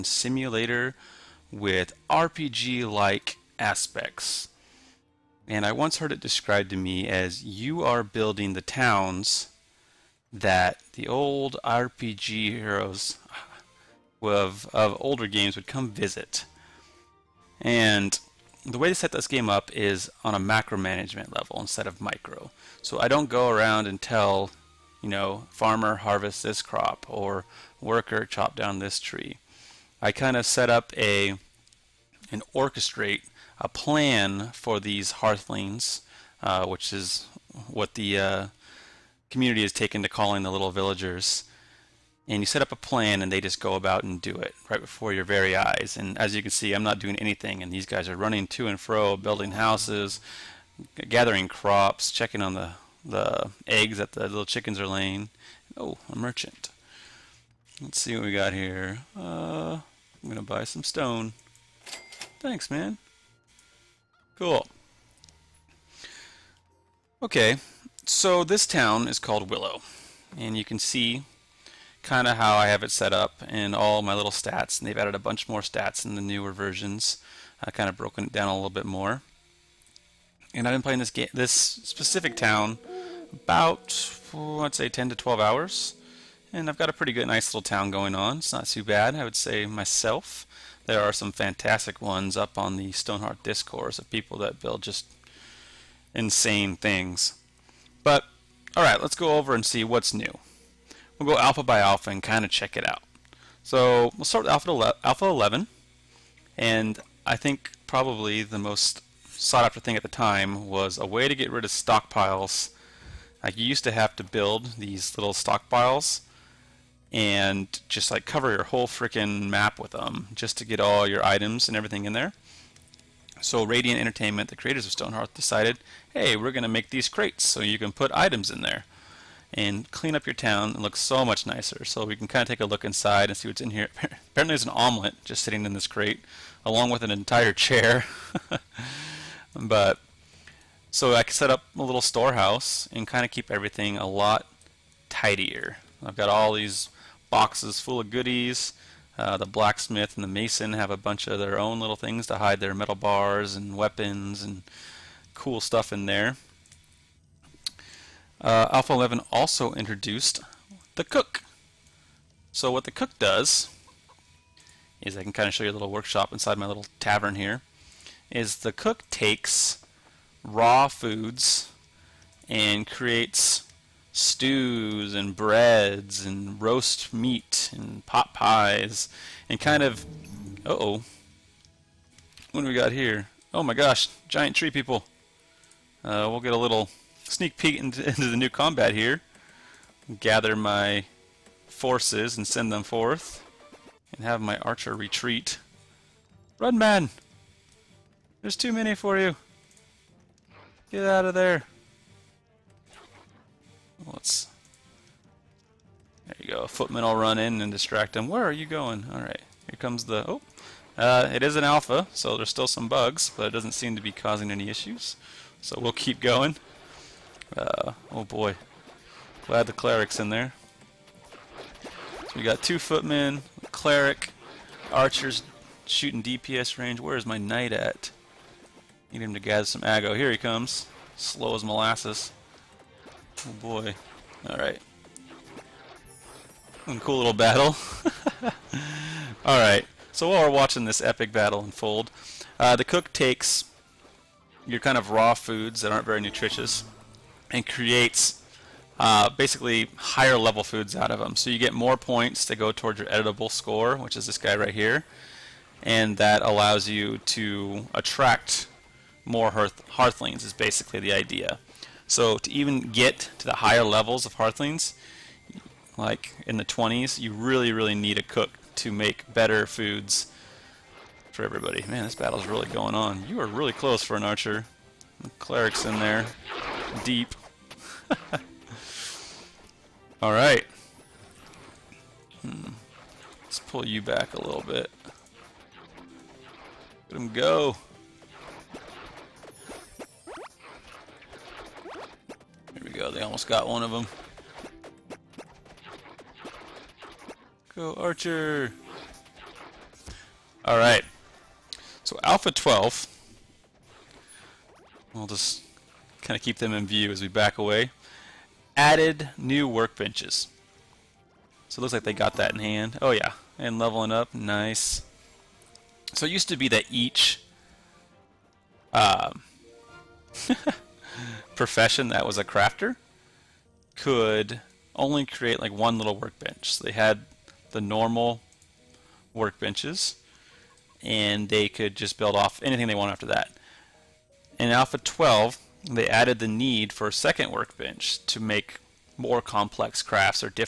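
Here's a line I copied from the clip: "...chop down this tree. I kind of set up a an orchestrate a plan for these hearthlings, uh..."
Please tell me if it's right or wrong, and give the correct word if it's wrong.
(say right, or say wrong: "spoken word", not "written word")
right.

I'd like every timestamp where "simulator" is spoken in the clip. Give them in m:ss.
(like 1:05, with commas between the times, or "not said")
0:00.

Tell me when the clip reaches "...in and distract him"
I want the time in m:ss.
3:27.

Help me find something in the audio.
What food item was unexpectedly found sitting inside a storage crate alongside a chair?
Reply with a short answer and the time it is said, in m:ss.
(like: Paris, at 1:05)
An omelet, at 2:14.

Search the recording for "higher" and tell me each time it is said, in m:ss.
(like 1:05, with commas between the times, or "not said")
4:09, 4:23.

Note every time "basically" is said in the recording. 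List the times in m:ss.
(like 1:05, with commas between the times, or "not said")
4:09, 4:20.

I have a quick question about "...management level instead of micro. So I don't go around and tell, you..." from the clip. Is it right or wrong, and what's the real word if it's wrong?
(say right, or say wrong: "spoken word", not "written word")
right.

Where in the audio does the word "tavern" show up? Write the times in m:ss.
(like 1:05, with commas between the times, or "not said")
2:46.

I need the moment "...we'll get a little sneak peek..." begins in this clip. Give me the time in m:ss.
3:06.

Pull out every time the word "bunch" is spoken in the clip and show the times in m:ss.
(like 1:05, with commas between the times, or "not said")
1:15, 2:30.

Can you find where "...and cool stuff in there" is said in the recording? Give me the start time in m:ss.
2:34.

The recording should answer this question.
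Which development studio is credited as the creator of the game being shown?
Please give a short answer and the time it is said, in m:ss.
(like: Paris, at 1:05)
Radiant Entertainment, at 2:03.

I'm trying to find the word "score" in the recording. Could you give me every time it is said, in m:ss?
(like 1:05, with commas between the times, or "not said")
4:13.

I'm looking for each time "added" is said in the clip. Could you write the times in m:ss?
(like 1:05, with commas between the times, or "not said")
1:14, 5:08, 5:36.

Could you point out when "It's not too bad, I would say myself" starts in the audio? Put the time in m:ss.
1:28.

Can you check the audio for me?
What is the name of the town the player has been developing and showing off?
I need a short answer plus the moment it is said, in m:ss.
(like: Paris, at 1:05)
Willow, at 1:09.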